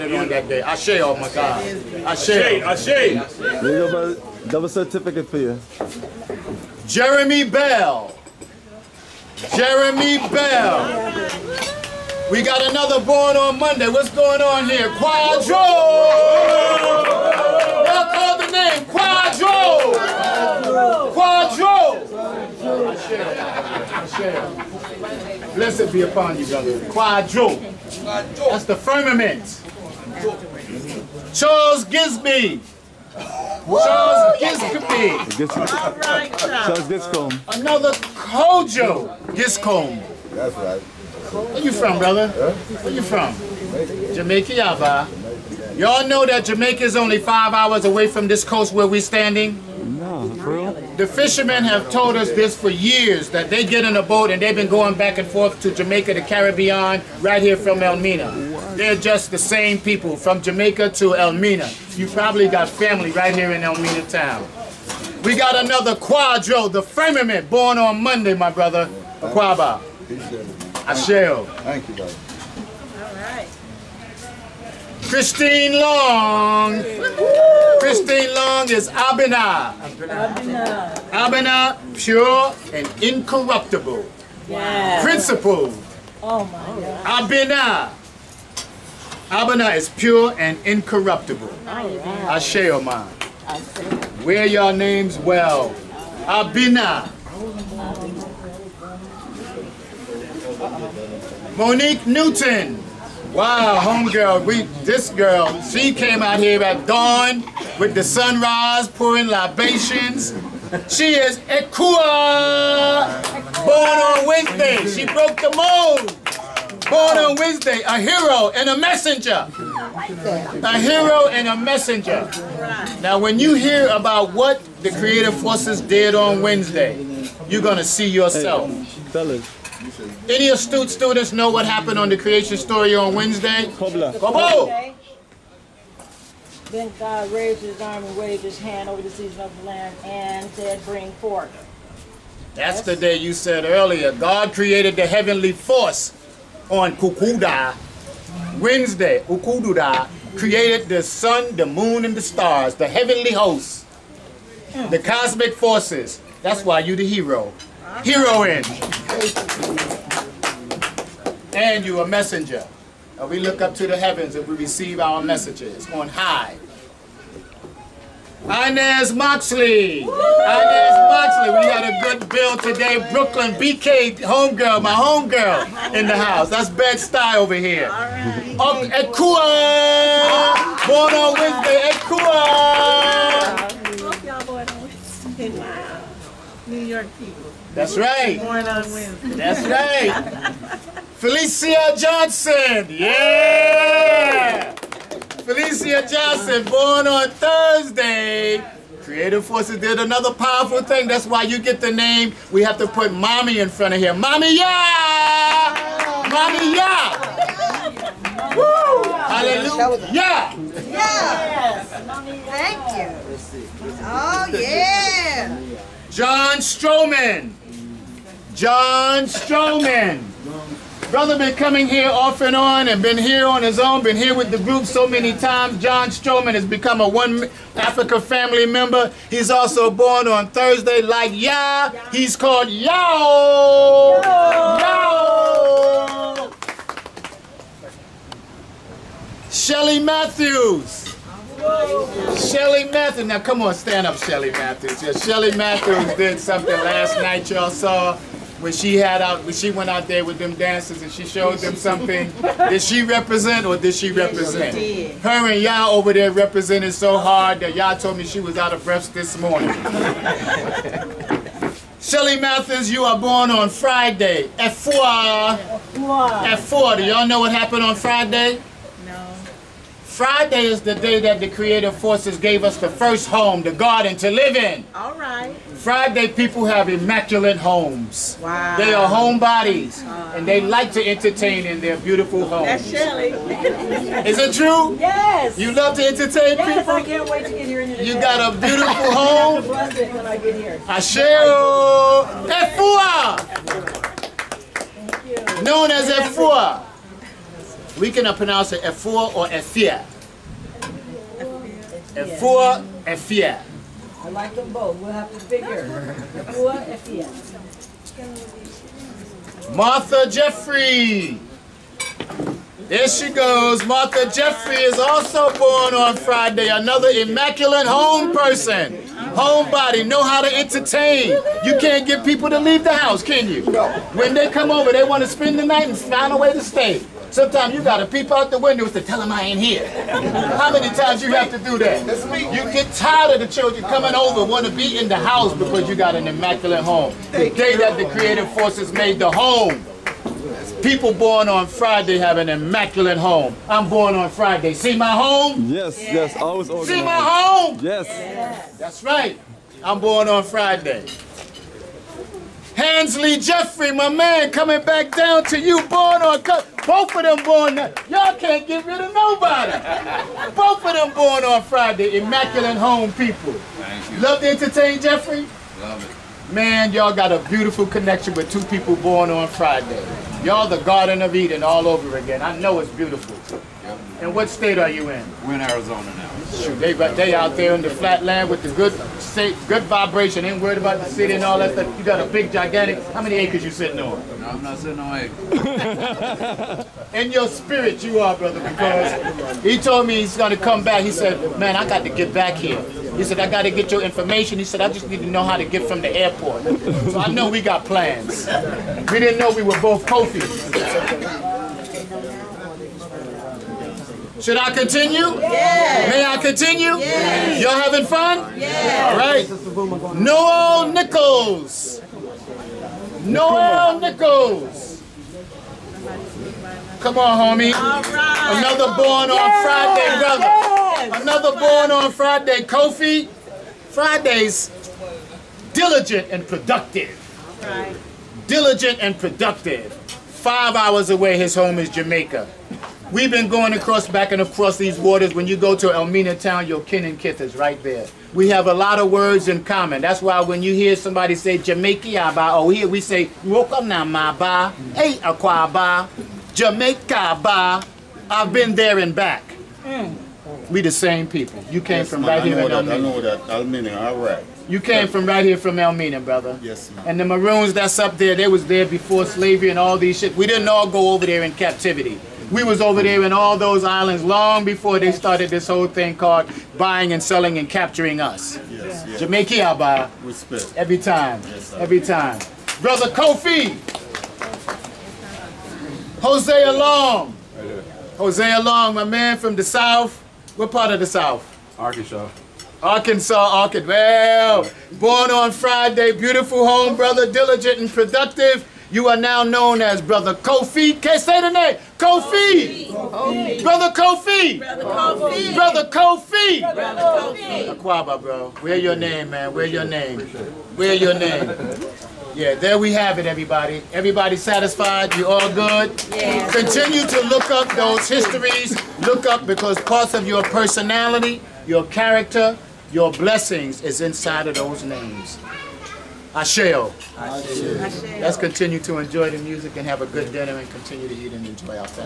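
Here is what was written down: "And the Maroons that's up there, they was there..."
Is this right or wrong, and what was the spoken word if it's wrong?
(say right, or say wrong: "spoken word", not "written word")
right.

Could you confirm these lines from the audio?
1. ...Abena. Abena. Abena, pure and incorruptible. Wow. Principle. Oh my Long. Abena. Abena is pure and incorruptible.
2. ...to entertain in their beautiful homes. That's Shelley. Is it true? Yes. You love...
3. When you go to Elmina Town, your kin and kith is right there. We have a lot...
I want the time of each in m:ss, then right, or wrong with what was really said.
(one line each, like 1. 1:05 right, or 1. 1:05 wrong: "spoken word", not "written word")
1. 1:18 wrong: "God", not "Long"
2. 4:40 right
3. 7:15 right.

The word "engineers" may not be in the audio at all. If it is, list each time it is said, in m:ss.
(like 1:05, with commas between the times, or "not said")
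not said.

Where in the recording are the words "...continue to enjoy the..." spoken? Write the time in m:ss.
8:38.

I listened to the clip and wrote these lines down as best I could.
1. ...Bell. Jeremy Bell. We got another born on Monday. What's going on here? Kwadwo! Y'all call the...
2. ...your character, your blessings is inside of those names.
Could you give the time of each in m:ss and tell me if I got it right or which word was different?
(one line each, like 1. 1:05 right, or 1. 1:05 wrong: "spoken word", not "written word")
1. 0:07 right
2. 8:31 right.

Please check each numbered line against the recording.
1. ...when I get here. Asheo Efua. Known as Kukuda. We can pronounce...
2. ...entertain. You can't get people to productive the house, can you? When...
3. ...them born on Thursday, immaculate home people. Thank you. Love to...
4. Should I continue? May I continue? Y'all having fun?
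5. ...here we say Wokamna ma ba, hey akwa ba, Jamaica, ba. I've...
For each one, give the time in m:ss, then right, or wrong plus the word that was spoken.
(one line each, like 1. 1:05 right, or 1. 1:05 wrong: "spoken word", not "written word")
1. 4:50 wrong: "Efua", not "Kukuda"
2. 5:20 wrong: "leave", not "productive"
3. 6:00 wrong: "Friday", not "Thursday"
4. 6:44 right
5. 7:22 right.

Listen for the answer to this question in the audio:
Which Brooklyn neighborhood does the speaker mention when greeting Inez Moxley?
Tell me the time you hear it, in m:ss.
2:56.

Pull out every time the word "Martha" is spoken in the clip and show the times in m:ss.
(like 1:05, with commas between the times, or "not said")
5:09, 5:13.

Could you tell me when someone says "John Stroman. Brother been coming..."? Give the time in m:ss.
3:38.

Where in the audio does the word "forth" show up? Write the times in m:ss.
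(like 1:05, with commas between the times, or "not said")
0:55, 2:21.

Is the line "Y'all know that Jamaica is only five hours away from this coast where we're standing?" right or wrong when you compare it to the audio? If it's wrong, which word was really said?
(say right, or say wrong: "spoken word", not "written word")
right.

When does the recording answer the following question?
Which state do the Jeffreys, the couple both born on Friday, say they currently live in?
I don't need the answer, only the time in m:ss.
6:15.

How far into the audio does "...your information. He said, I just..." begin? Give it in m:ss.
6:33.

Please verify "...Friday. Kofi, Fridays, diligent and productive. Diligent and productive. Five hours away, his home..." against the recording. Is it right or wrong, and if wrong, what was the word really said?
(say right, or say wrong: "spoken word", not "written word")
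right.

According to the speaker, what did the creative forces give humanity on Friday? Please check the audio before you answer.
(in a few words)
The first home, the garden.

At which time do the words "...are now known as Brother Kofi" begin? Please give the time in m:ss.
8:09.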